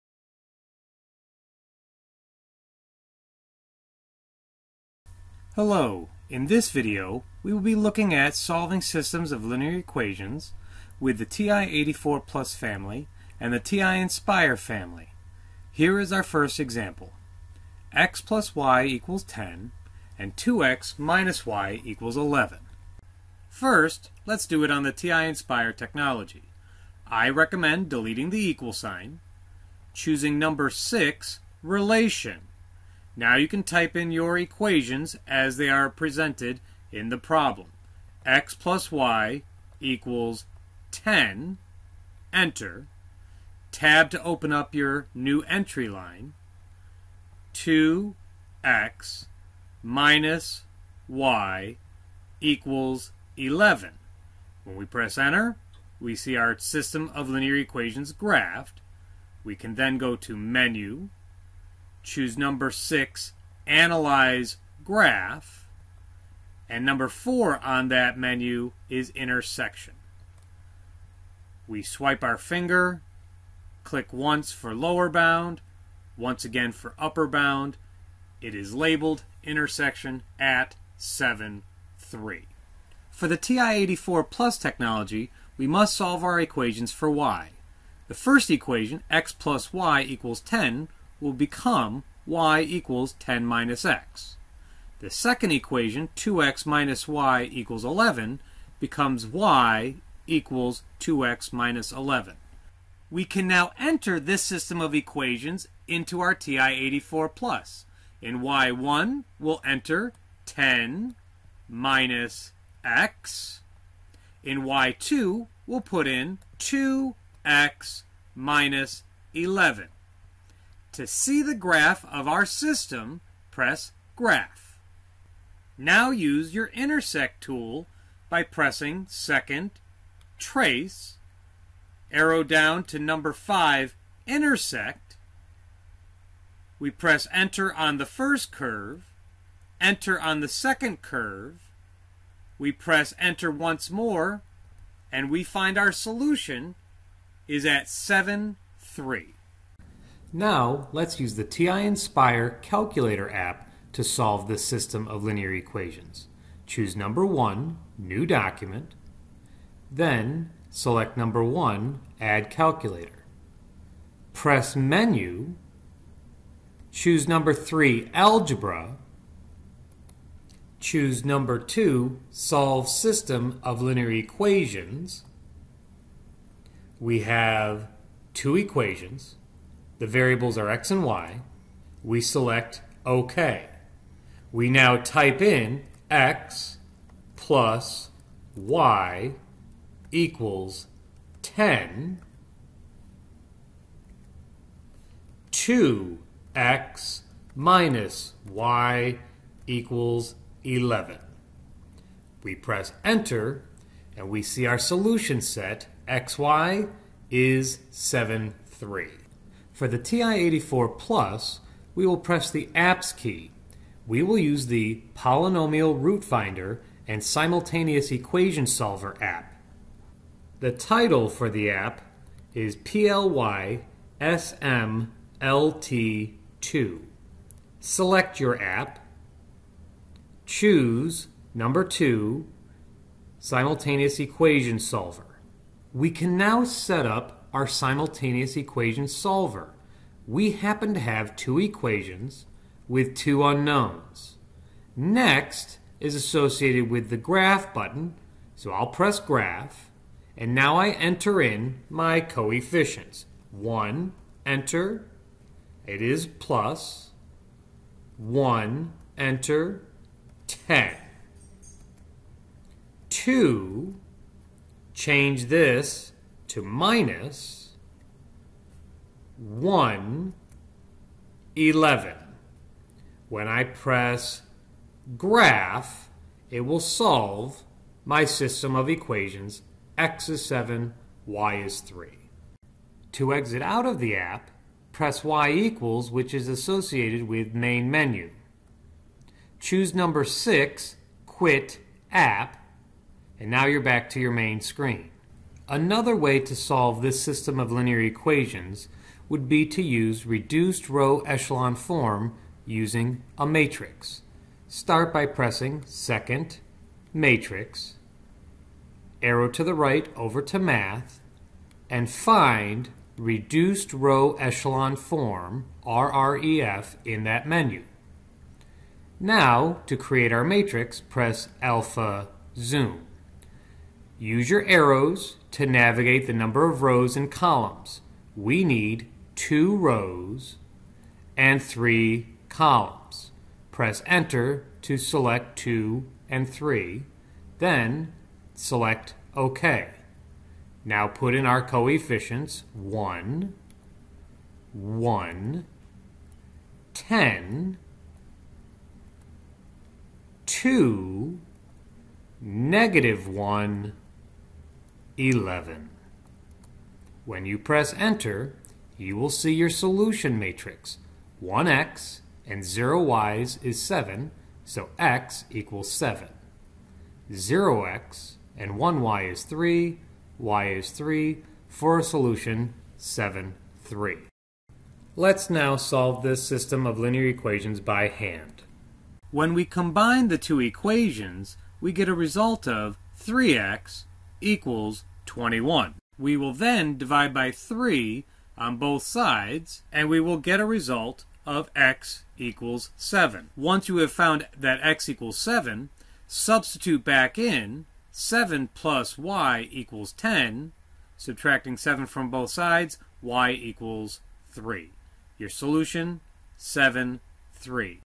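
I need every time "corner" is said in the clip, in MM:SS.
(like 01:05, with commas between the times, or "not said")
not said.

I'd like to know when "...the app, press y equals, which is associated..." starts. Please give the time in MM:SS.
04:43.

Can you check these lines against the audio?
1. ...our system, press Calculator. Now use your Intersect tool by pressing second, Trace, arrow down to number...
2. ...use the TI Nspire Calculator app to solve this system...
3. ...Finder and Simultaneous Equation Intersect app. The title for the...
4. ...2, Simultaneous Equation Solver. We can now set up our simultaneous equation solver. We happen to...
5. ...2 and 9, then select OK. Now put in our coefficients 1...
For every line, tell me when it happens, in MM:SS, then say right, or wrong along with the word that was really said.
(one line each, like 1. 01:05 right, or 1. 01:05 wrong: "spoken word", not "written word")
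1. 02:02 wrong: "Graph", not "Calculator"
2. 02:31 right
3. 03:36 wrong: "Solver", not "Intersect"
4. 03:51 right
5. 05:35 wrong: "3", not "9".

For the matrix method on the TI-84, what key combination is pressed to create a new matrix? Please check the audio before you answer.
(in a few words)
alpha zoom.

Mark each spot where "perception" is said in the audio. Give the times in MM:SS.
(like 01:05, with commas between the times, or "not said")
not said.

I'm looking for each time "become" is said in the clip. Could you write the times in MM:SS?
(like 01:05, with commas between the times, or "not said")
01:31, 01:38.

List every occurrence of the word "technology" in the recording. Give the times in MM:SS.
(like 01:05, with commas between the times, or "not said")
00:25, 01:24.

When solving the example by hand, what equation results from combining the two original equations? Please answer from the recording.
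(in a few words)
3x = 21.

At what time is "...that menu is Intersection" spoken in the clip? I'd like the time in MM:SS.
01:07.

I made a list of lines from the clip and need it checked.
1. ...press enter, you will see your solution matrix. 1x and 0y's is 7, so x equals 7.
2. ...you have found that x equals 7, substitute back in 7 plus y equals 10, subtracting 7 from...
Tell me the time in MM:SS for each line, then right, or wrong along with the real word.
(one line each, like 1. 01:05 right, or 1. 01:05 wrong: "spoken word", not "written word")
1. 05:57 right
2. 06:33 right.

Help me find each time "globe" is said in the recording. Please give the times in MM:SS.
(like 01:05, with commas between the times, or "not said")
not said.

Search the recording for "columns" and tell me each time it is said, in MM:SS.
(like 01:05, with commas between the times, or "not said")
05:27, 05:32.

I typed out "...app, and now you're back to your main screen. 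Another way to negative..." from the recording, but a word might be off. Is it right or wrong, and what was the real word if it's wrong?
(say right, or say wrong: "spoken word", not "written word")
wrong: "solve", not "negative".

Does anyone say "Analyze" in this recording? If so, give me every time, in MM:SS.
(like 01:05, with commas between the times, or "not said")
01:03.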